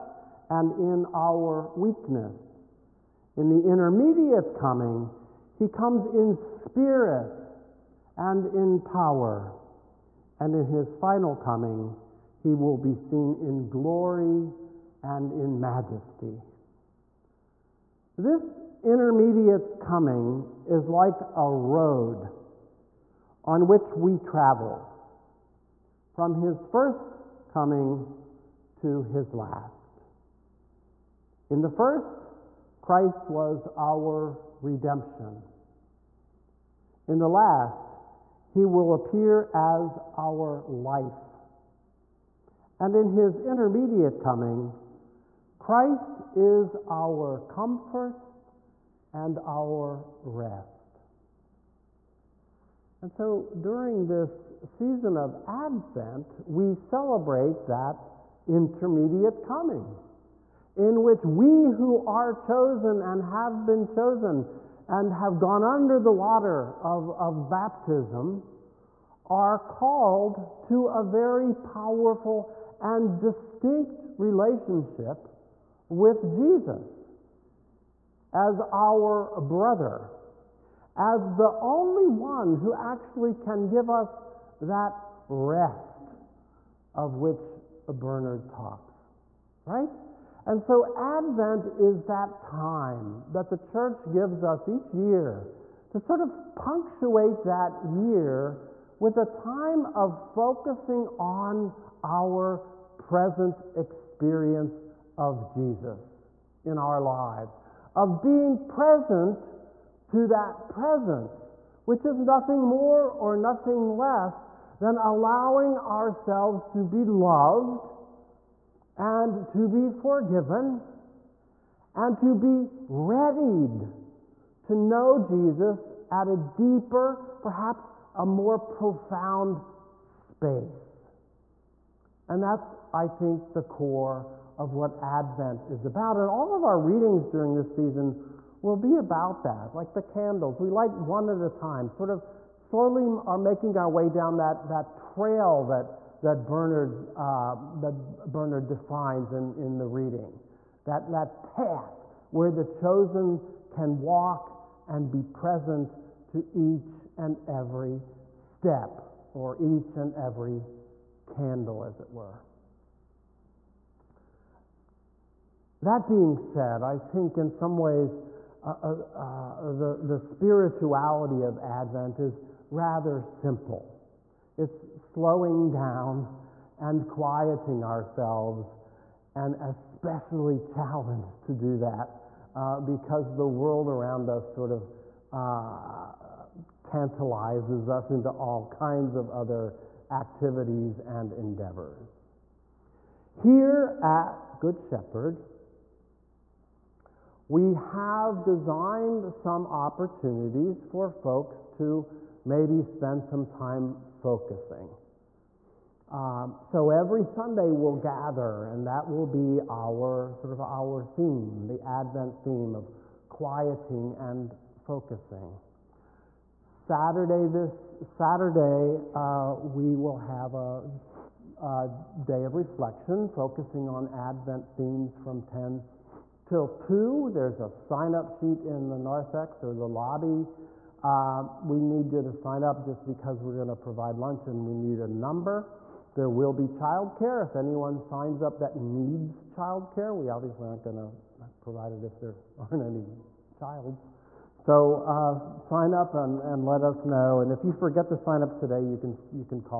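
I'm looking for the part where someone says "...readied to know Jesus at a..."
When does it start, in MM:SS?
02:02.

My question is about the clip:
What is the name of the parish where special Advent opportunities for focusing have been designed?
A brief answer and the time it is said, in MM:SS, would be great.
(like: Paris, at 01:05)
Good Shepherd, at 03:14.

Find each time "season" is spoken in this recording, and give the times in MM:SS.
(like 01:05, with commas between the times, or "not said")
00:54, 02:17.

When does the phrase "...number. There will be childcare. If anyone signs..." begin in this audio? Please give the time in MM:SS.
03:55.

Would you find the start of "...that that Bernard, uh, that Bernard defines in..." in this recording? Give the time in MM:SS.
02:25.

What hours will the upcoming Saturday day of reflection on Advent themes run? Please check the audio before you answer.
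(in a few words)
10 till 2.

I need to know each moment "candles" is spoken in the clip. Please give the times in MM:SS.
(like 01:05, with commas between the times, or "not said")
02:20, 02:41.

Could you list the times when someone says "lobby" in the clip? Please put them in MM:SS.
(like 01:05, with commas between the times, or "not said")
03:49.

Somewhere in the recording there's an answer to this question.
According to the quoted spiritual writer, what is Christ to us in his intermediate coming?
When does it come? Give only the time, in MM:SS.
00:46.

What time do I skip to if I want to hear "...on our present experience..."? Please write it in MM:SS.
01:41.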